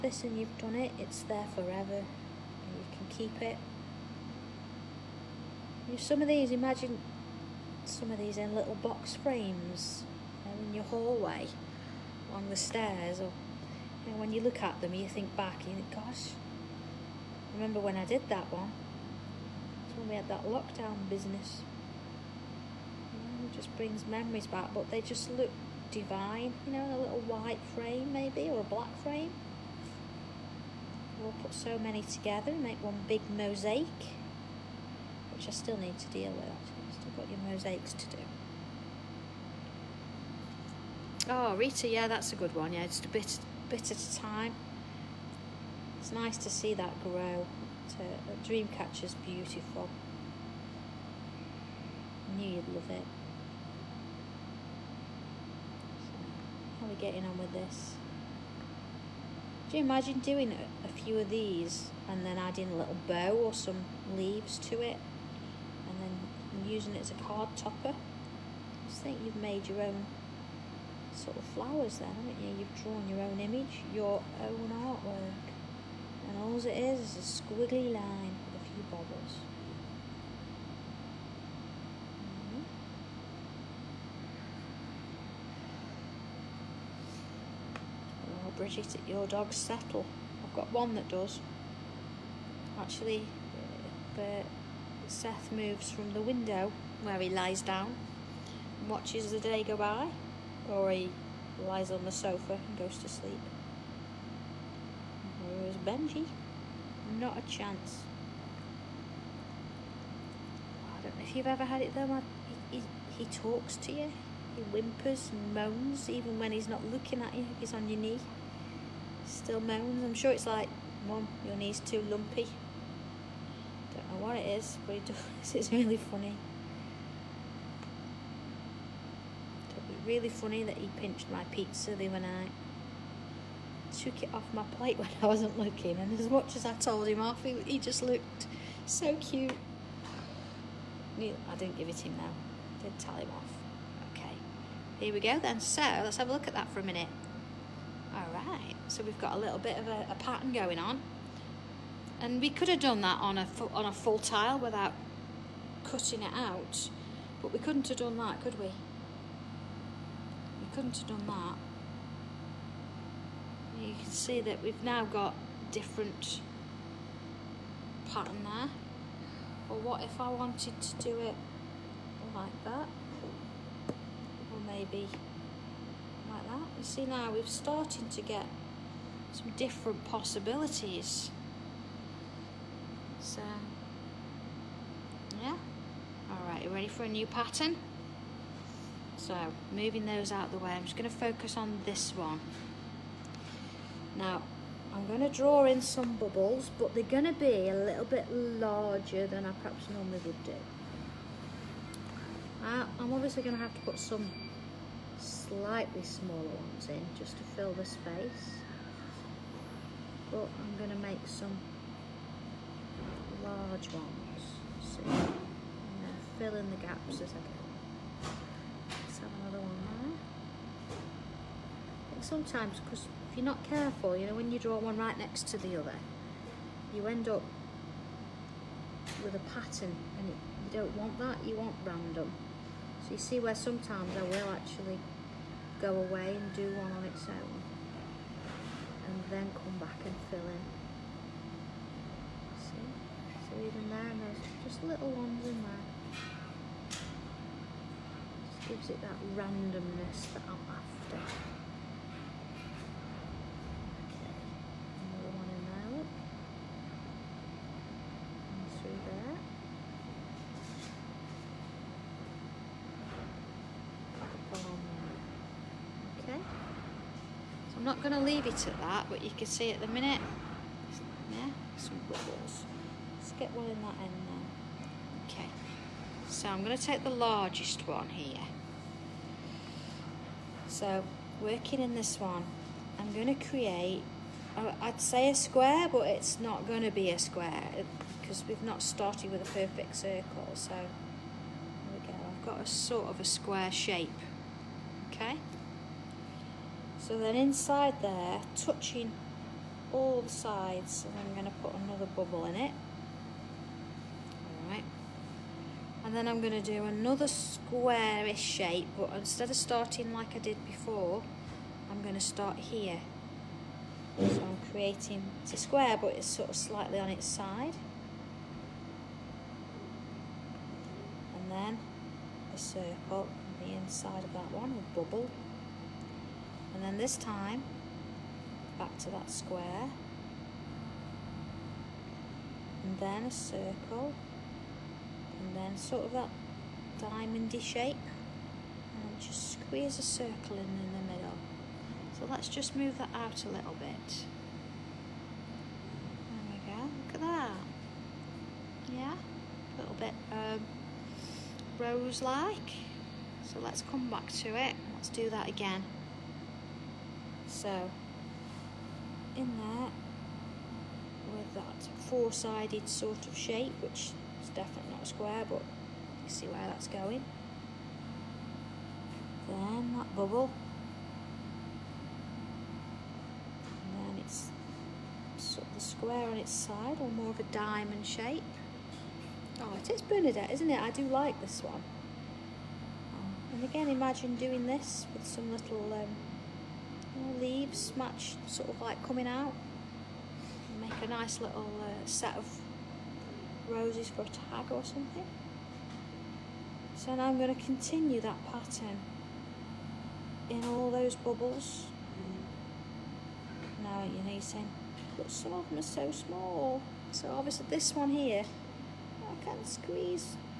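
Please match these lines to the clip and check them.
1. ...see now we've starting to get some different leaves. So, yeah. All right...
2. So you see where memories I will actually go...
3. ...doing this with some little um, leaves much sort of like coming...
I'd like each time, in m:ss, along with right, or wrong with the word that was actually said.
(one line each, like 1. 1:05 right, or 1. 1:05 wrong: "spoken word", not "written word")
1. 2:56 wrong: "possibilities", not "leaves"
2. 3:53 wrong: "sometimes", not "memories"
3. 6:24 right.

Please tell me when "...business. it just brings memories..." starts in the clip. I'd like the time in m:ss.
0:21.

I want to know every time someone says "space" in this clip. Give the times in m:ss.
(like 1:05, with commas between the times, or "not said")
3:27.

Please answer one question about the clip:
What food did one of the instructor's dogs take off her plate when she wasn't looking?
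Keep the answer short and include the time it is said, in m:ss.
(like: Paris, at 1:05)
Pizza, at 2:11.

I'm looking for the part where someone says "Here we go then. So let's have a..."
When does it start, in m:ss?
2:24.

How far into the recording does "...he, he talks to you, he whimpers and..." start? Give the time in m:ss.
1:52.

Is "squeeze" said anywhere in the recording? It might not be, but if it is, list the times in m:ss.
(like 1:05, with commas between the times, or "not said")
5:39, 6:49.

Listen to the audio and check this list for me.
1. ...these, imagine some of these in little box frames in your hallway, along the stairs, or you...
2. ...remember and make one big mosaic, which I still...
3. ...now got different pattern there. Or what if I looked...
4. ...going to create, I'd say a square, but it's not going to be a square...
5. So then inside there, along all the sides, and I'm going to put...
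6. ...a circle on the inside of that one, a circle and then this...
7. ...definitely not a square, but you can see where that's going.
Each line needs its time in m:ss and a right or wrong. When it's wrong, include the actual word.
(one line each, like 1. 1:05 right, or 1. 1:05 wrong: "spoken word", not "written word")
1. 0:06 right
2. 0:32 wrong: "together", not "remember"
3. 2:44 wrong: "wanted", not "looked"
4. 4:43 right
5. 4:57 wrong: "touching", not "along"
6. 5:22 wrong: "bubble", not "circle"
7. 6:04 right.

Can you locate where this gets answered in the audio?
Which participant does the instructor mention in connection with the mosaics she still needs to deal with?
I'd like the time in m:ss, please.
0:41.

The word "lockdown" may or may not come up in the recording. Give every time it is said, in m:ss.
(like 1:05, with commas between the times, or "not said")
0:20.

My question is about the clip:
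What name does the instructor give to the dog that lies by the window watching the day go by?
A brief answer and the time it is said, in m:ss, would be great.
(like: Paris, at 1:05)
Seth, at 1:35.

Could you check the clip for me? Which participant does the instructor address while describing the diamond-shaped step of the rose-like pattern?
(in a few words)
Bernadette.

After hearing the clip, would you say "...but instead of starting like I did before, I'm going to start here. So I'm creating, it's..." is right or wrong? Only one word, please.
right.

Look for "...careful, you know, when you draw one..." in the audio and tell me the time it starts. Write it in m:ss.
3:43.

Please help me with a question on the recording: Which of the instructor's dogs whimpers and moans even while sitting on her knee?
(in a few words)
Benji.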